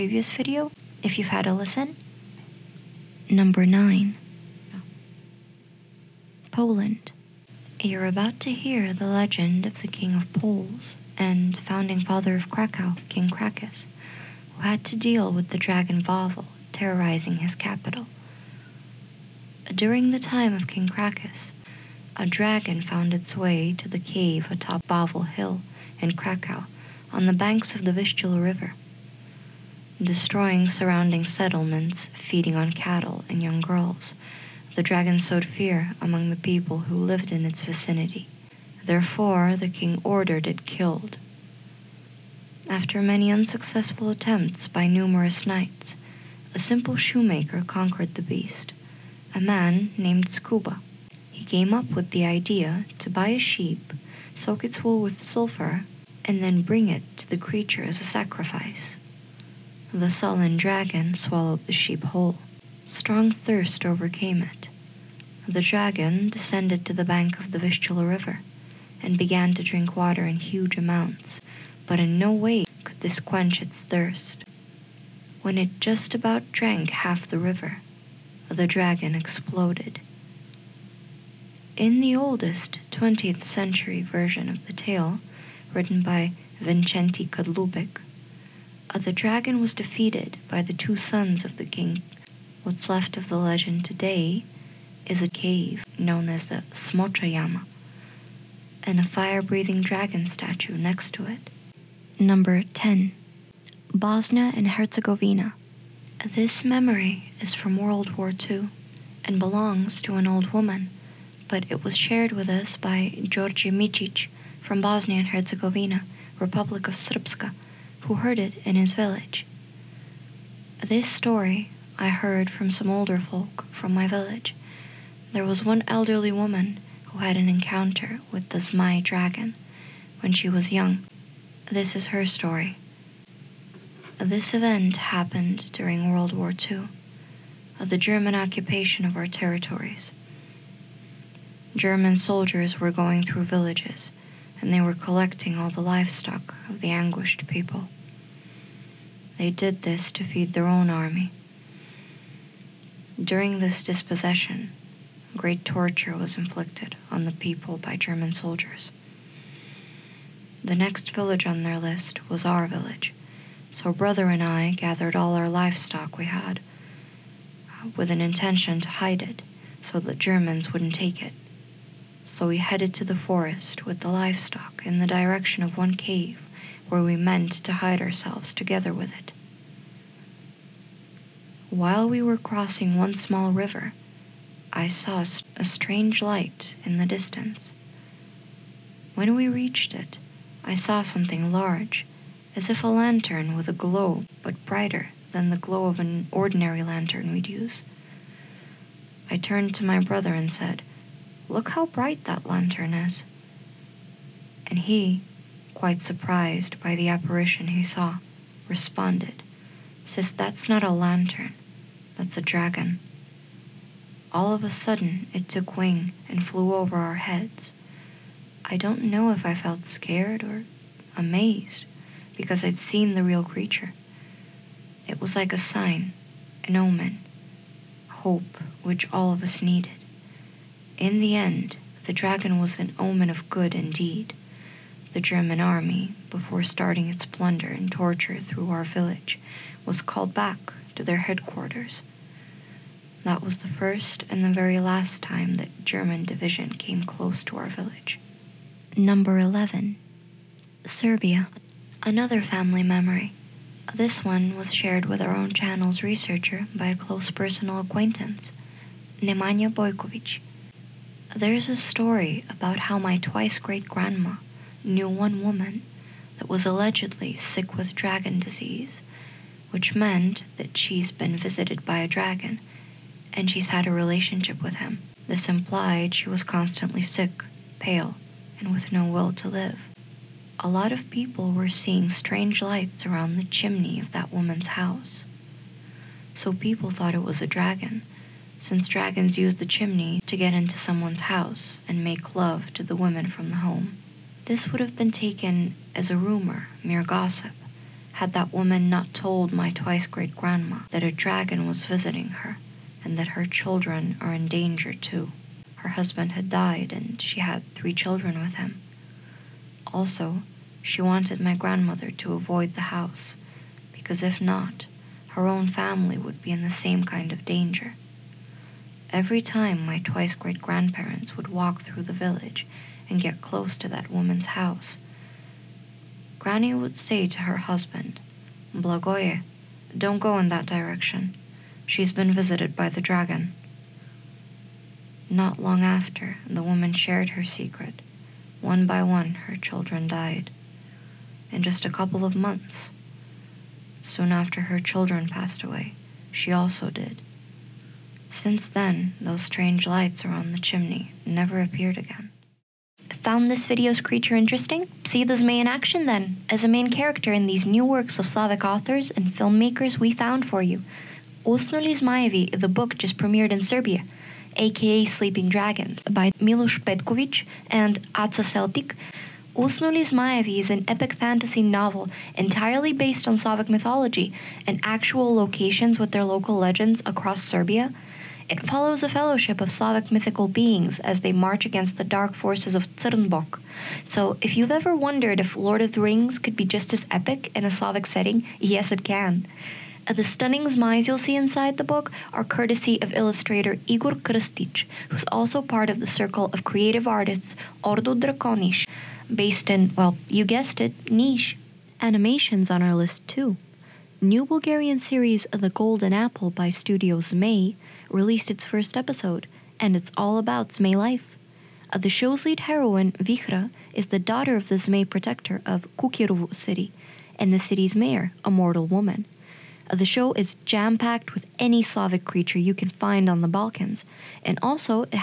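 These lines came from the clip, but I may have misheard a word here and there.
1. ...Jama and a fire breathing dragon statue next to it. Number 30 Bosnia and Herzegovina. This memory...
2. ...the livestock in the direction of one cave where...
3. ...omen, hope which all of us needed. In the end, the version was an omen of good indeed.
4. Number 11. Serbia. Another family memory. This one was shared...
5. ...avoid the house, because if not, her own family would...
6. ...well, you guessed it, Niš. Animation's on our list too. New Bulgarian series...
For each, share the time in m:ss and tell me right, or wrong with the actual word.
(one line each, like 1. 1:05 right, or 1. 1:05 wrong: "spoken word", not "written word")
1. 1:37 wrong: "10", not "30"
2. 2:54 right
3. 3:46 wrong: "dragon", not "version"
4. 4:08 right
5. 5:12 right
6. 6:39 right.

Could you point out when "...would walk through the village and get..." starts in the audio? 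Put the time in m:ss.
5:21.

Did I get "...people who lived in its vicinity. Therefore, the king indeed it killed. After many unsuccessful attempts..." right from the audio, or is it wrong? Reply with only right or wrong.
wrong.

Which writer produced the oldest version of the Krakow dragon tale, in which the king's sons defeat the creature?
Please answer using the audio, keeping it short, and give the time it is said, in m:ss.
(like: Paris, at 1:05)
Wincenty Kadlubek, at 1:26.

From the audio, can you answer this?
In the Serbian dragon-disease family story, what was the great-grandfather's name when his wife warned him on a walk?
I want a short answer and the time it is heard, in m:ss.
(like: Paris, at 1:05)
Blagoye, at 5:28.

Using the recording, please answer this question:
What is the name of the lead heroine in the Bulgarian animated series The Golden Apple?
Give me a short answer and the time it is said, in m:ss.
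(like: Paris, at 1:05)
Vihra, at 6:53.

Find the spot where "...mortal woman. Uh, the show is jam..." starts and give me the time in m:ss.
6:58.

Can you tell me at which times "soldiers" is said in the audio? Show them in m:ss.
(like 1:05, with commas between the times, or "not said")
2:22, 2:38.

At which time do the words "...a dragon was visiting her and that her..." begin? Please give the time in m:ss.
5:01.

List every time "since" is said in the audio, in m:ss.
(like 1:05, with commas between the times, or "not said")
4:48, 5:48.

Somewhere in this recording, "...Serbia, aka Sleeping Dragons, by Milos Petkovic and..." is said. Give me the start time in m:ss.
6:03.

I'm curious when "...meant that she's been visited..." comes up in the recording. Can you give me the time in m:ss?
4:29.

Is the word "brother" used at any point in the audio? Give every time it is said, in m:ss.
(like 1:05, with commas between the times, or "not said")
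2:43, 3:19.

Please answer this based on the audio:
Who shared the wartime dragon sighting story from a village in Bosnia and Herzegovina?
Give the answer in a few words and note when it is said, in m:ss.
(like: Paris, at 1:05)
Georgi Micic, at 1:53.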